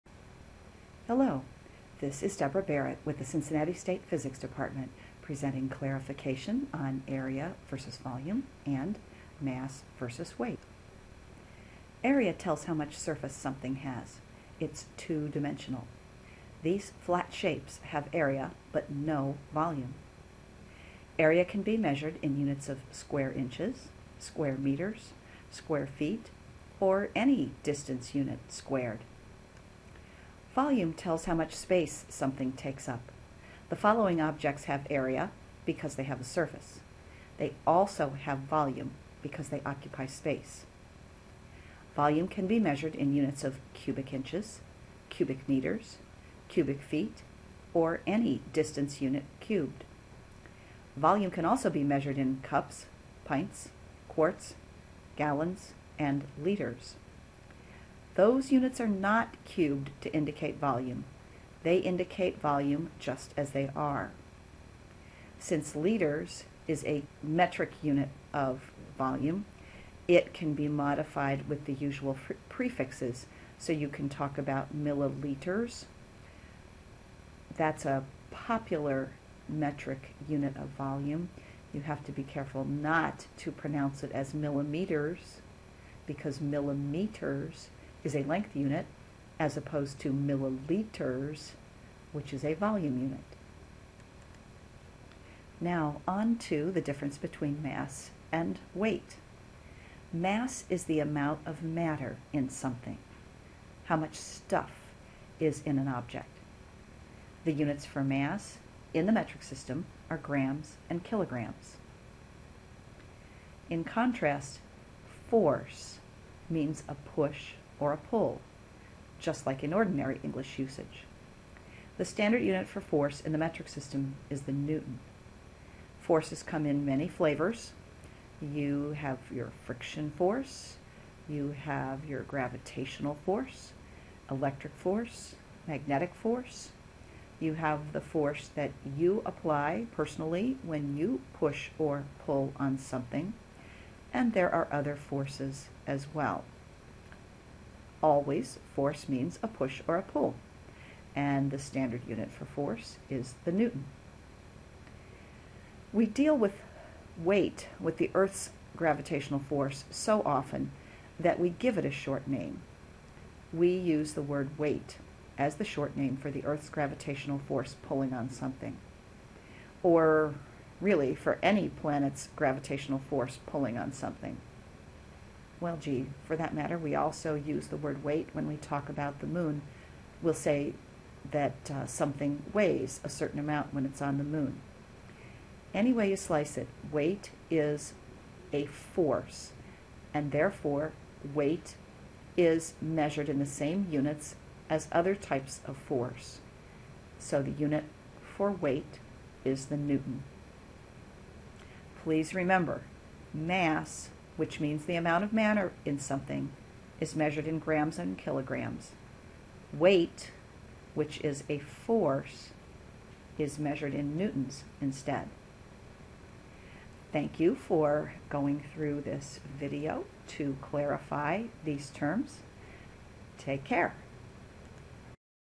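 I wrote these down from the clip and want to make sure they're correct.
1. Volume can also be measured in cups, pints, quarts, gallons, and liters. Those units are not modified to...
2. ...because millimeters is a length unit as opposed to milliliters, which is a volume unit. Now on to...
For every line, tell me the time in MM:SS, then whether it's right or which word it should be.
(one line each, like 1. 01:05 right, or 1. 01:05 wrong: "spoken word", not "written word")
1. 00:50 wrong: "cubed", not "modified"
2. 01:26 right.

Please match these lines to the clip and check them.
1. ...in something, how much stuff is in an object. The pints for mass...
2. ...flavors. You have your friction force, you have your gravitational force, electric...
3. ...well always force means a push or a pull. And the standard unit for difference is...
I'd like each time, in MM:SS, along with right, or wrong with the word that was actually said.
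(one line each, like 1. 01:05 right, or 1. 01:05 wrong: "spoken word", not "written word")
1. 01:42 wrong: "units", not "pints"
2. 02:07 right
3. 02:26 wrong: "force", not "difference".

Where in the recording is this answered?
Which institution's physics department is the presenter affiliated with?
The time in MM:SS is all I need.
00:03.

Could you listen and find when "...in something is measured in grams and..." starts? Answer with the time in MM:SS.
03:25.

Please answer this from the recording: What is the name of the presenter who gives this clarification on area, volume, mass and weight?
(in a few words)
Deborah Barrett.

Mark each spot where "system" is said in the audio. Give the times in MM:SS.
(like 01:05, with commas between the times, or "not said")
01:49, 02:03.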